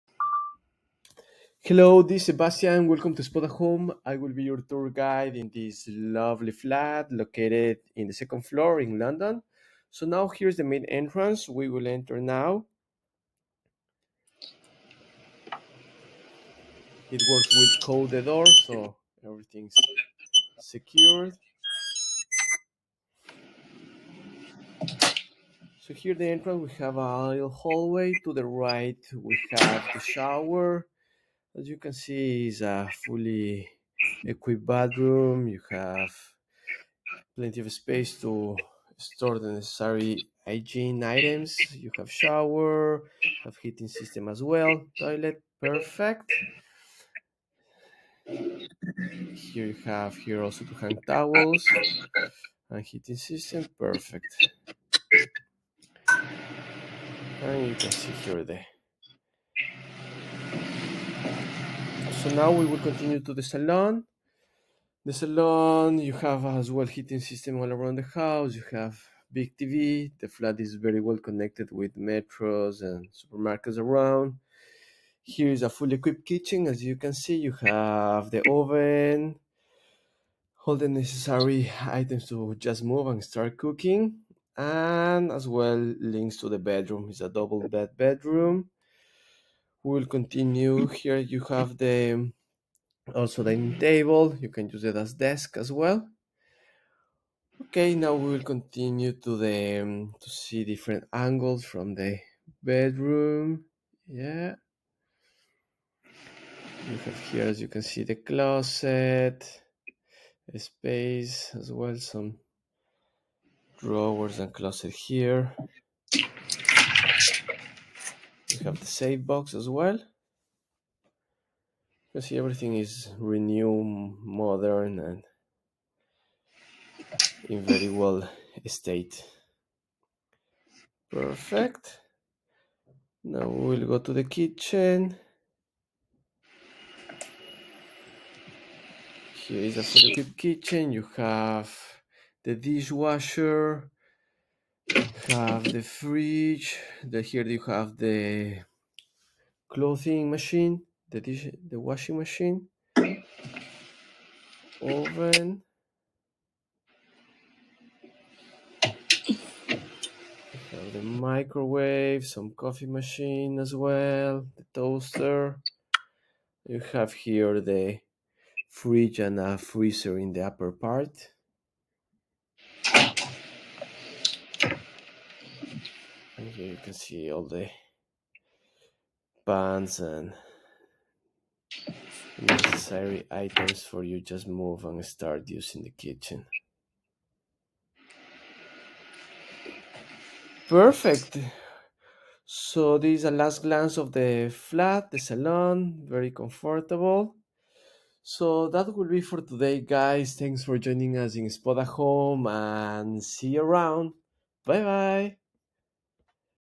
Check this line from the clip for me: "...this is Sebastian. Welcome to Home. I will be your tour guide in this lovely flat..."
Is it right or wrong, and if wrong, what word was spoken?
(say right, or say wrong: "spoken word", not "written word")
wrong: "Spotahome", not "Home".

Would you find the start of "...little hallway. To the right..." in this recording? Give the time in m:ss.
0:27.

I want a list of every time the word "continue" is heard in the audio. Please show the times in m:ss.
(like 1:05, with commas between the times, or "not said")
1:02, 1:30, 1:38.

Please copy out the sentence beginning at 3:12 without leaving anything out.
So this is a last glance of the flat, the salon, very comfortable.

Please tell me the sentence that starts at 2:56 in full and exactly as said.
Here you can see all the bands and necessary items for you just move and start using the kitchen.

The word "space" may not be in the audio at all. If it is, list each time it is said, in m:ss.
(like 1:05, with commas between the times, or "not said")
0:37, 1:50.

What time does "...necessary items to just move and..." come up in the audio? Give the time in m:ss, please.
1:20.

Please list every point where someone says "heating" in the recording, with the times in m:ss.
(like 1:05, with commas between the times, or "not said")
0:43, 0:52, 1:06.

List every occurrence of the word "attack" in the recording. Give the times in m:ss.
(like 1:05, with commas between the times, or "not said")
not said.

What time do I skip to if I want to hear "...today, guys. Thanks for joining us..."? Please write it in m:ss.
3:19.